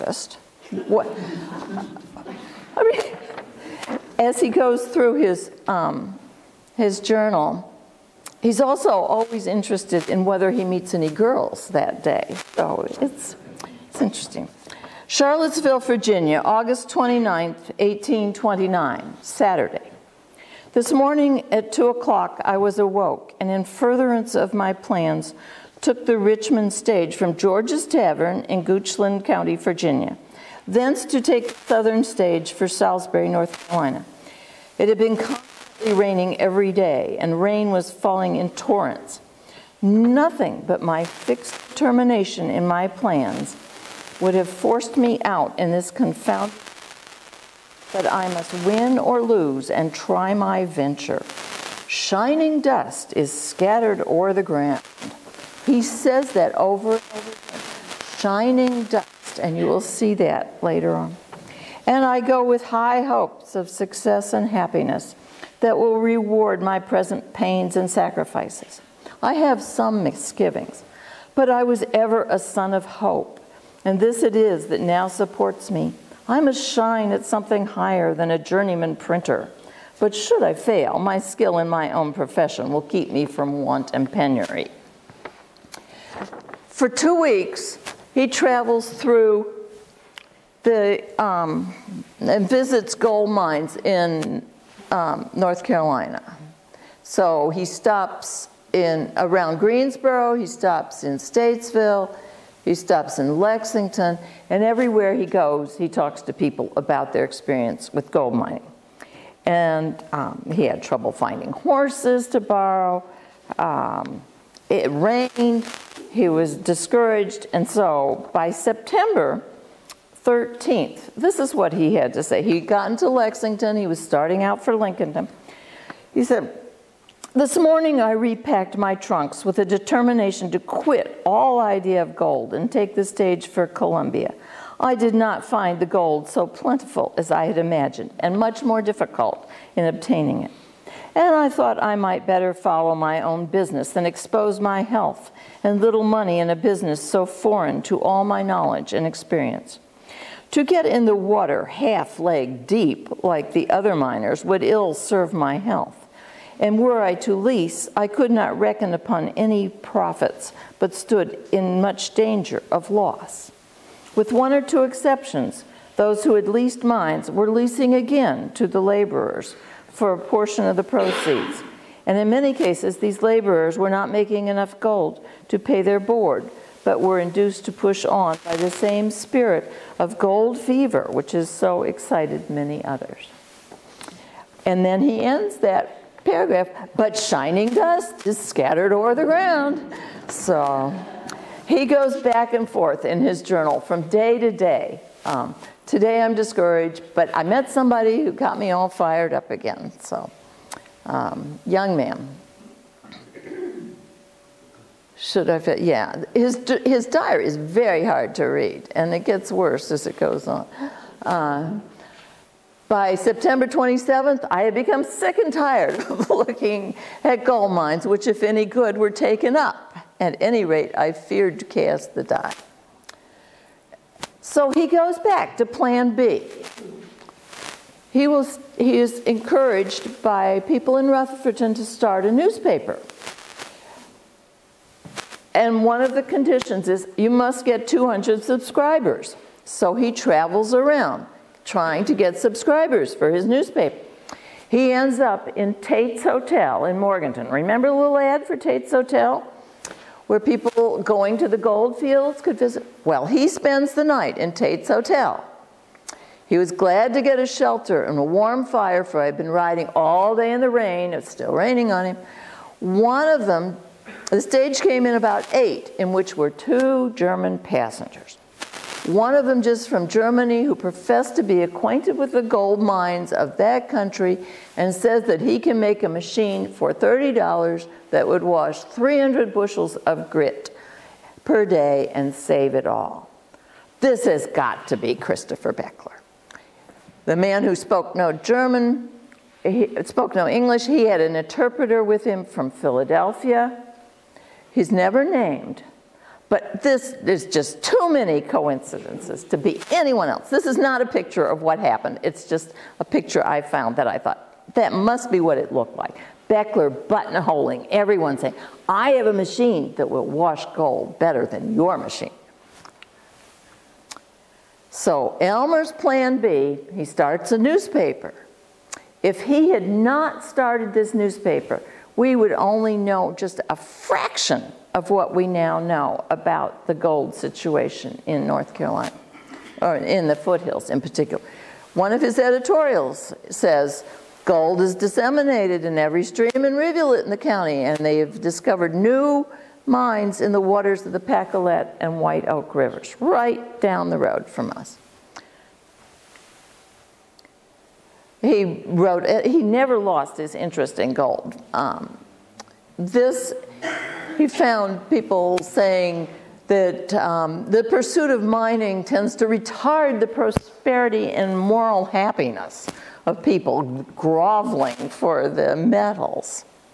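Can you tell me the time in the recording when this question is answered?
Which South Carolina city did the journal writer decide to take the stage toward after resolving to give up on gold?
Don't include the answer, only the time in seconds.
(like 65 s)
133 s.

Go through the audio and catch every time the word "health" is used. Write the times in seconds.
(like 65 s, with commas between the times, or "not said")
144 s, 155 s.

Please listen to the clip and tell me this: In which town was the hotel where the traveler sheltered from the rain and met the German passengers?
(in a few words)
Morganton.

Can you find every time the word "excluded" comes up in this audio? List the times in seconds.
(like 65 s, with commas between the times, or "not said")
not said.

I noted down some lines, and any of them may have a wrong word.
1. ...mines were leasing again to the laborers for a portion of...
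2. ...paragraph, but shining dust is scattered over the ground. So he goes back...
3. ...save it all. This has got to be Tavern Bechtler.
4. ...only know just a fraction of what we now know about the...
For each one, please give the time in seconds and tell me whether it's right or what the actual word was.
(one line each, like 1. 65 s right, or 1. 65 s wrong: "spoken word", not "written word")
1. 166 s right
2. 186 s right
3. 282 s wrong: "Christopher", not "Tavern"
4. 322 s right.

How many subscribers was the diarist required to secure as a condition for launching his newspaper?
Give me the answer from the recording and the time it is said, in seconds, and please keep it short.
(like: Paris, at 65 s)
200, at 237 s.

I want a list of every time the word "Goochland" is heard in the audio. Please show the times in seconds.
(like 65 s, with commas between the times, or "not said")
28 s.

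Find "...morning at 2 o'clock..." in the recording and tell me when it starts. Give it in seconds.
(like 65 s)
20 s.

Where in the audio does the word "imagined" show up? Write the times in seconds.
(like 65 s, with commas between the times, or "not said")
137 s.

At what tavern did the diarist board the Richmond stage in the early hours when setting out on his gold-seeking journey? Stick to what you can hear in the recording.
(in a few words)
George's Tavern.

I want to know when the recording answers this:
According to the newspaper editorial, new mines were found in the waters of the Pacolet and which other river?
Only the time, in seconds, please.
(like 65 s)
342 s.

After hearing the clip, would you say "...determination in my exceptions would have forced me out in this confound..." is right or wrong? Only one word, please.
wrong.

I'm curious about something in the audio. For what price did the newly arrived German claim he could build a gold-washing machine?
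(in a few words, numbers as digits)
$30.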